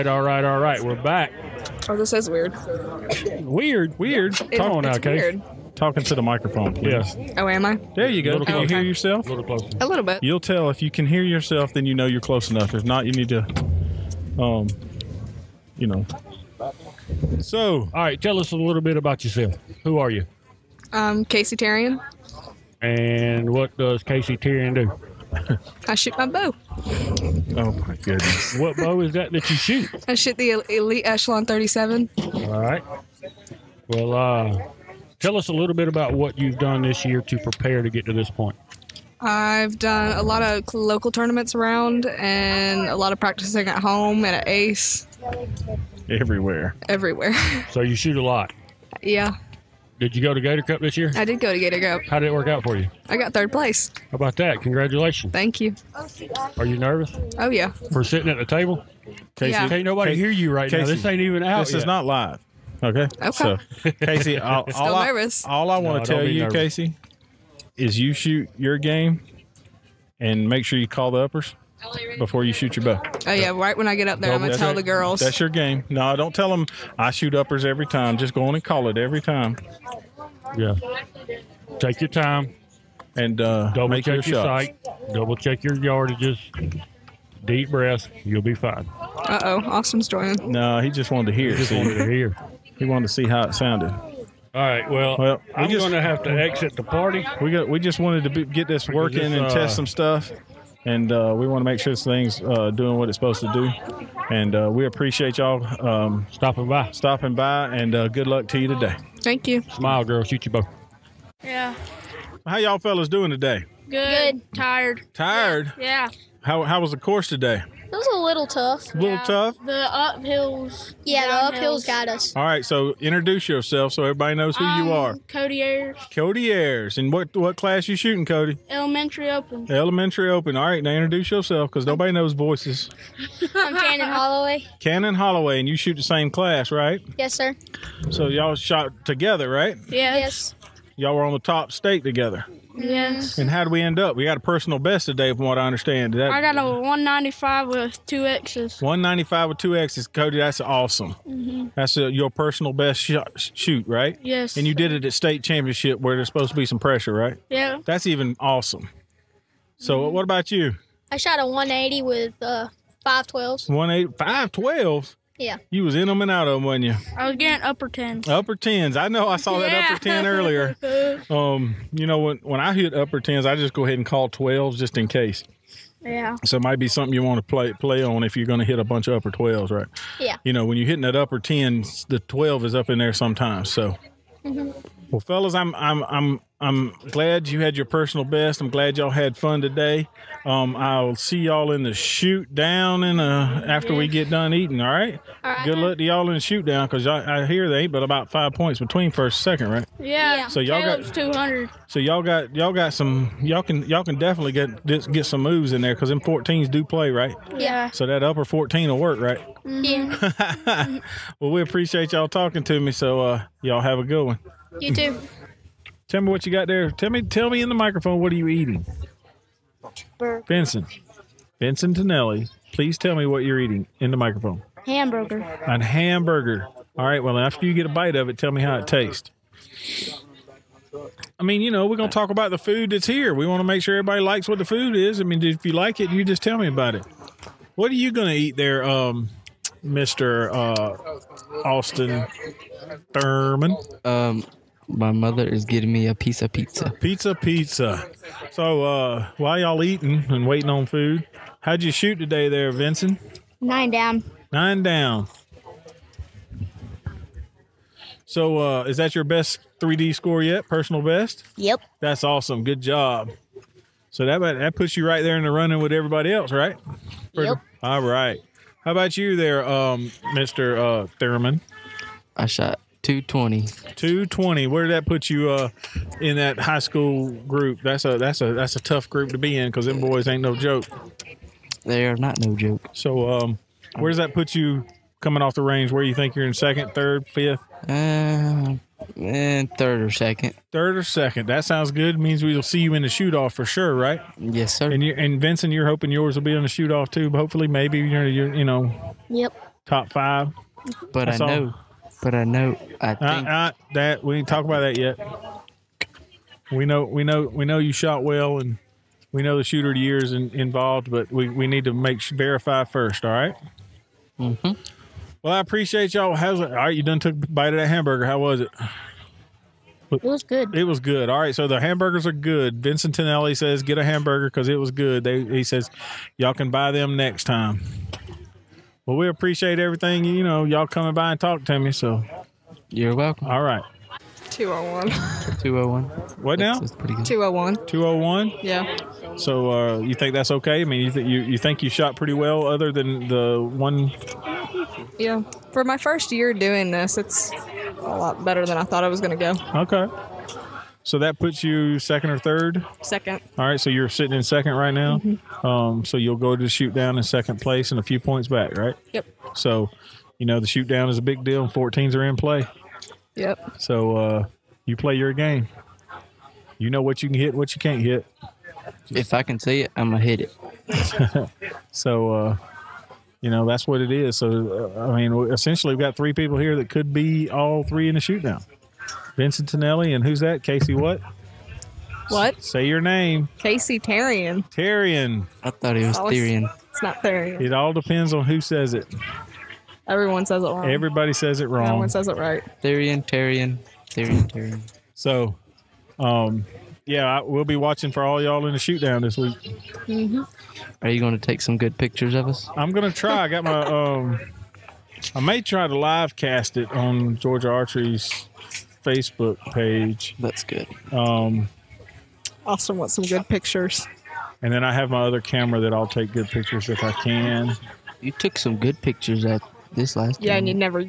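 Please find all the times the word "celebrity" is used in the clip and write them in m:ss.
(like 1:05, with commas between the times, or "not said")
not said.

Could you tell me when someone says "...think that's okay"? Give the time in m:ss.
5:40.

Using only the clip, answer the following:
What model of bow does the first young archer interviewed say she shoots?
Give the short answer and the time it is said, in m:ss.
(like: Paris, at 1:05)
Elite Echelon 37, at 0:30.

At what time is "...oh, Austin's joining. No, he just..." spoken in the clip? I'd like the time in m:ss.
1:29.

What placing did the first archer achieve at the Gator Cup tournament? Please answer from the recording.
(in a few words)
Third place.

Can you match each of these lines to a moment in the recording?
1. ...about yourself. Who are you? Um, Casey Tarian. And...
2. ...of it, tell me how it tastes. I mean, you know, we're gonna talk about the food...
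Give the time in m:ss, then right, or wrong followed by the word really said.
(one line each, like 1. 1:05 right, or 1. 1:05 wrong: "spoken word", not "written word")
1. 0:18 right
2. 3:48 right.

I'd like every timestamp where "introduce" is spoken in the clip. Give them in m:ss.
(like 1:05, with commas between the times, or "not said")
2:03, 2:10.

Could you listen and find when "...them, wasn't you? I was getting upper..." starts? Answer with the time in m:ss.
2:46.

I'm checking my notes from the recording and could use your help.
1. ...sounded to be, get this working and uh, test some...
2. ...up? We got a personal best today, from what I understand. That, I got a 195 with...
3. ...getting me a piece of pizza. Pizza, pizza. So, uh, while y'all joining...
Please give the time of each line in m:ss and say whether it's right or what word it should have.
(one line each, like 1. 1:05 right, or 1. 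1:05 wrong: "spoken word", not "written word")
1. 1:37 wrong: "wanted", not "sounded"
2. 2:23 right
3. 4:05 wrong: "eating", not "joining".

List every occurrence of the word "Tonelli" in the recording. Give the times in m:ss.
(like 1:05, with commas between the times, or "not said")
3:41, 6:19.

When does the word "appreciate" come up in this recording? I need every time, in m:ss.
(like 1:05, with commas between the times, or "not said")
1:44, 3:31, 5:15, 5:29.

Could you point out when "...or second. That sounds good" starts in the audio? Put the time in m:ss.
4:50.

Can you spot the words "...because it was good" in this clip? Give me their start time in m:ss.
5:24.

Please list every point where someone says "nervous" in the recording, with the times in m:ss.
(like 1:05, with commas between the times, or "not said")
0:56, 1:06.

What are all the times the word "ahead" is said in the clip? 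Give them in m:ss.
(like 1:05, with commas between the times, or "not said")
2:53.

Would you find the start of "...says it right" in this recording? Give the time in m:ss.
6:32.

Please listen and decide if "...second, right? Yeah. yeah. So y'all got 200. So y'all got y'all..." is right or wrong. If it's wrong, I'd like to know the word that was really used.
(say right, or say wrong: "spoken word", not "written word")
right.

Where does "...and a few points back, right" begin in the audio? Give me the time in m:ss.
5:57.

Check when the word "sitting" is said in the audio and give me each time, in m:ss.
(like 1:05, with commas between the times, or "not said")
0:58, 5:54.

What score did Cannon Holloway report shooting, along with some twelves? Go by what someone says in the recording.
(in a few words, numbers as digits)
180.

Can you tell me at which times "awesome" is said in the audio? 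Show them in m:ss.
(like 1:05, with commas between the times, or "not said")
2:30, 2:38, 4:22.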